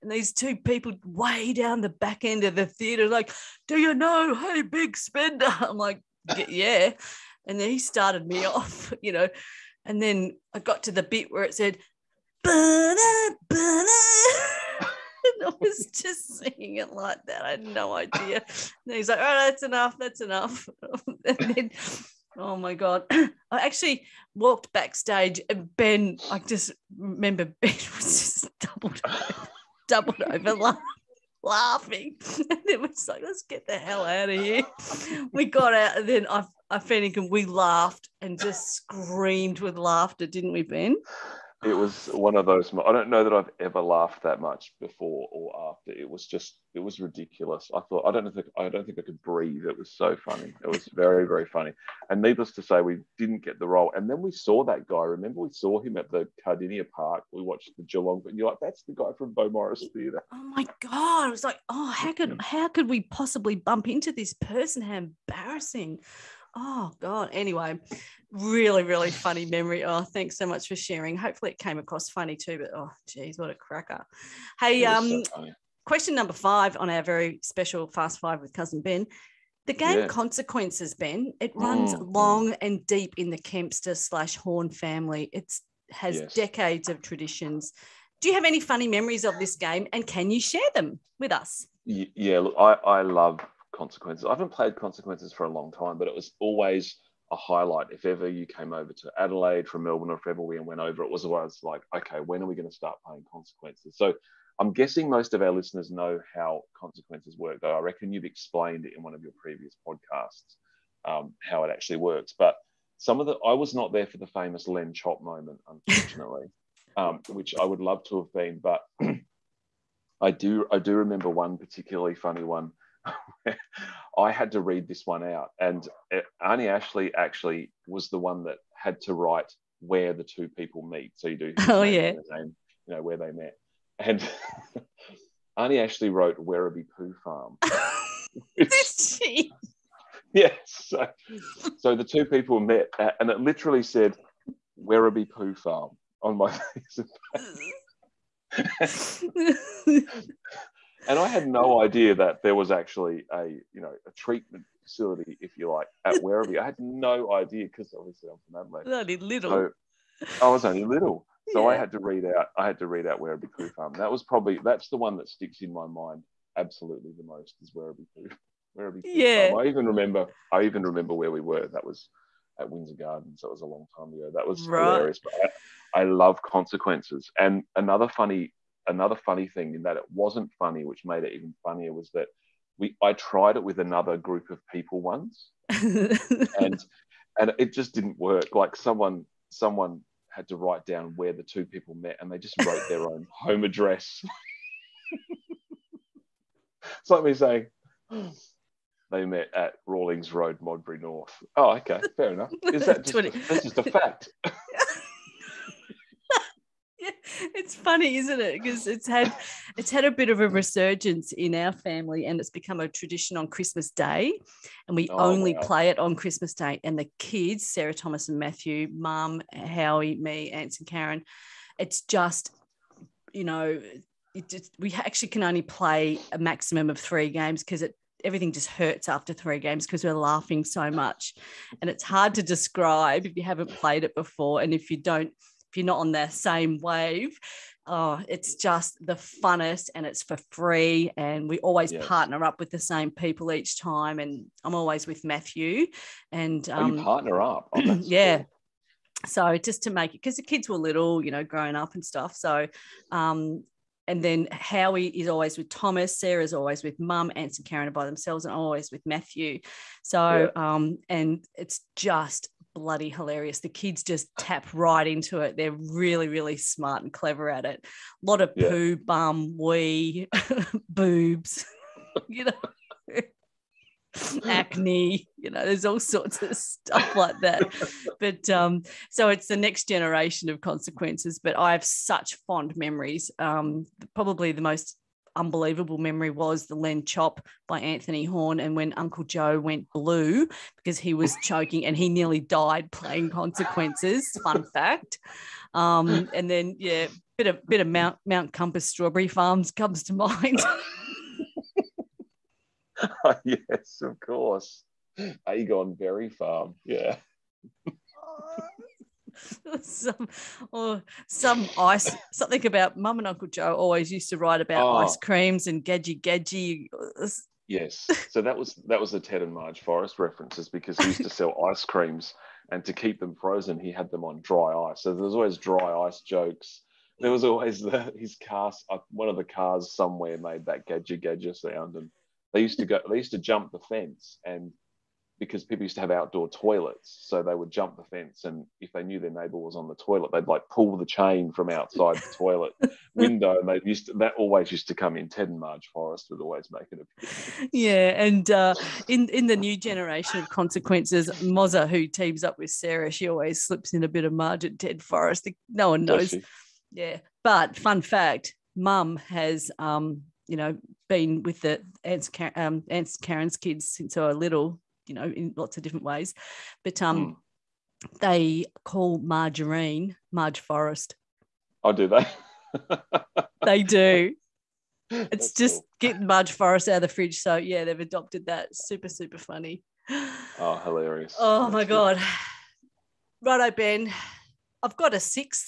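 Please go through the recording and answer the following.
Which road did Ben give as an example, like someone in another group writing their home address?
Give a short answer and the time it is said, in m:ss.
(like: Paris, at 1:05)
Rawlings Road, at 3:19.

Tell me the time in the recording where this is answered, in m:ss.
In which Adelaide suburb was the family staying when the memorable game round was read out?
2:52.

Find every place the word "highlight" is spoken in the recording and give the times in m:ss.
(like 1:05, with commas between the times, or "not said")
1:37.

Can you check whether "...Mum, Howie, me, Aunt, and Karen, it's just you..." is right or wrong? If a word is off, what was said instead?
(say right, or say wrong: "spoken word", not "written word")
right.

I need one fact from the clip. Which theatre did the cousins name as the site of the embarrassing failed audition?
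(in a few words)
Beaumaris Theatre.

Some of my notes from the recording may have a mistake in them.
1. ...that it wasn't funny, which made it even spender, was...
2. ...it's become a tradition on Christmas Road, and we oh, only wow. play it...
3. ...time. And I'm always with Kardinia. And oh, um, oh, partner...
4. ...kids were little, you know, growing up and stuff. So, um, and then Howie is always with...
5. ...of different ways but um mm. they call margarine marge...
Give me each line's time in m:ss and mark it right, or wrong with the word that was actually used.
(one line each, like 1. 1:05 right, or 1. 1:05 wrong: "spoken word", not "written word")
1. 2:59 wrong: "funnier", not "spender"
2. 3:32 wrong: "Day", not "Road"
3. 4:03 wrong: "Matthew", not "Kardinia"
4. 4:10 right
5. 6:05 right.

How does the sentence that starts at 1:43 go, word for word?
So I'm guessing most of our listeners know how Consequences work, though.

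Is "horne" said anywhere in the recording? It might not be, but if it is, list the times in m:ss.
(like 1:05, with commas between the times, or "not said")
1:24, 4:48.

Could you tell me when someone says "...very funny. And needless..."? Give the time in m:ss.
0:51.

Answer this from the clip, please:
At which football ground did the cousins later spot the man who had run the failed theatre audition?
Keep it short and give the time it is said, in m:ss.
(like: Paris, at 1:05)
Kardinia Park, at 0:56.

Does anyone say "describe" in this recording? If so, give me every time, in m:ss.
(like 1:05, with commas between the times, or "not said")
3:52.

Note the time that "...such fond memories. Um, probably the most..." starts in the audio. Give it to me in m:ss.
4:41.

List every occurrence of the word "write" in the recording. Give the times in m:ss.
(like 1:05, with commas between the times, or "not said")
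2:09, 3:10, 5:14.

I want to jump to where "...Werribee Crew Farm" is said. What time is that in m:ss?
2:43.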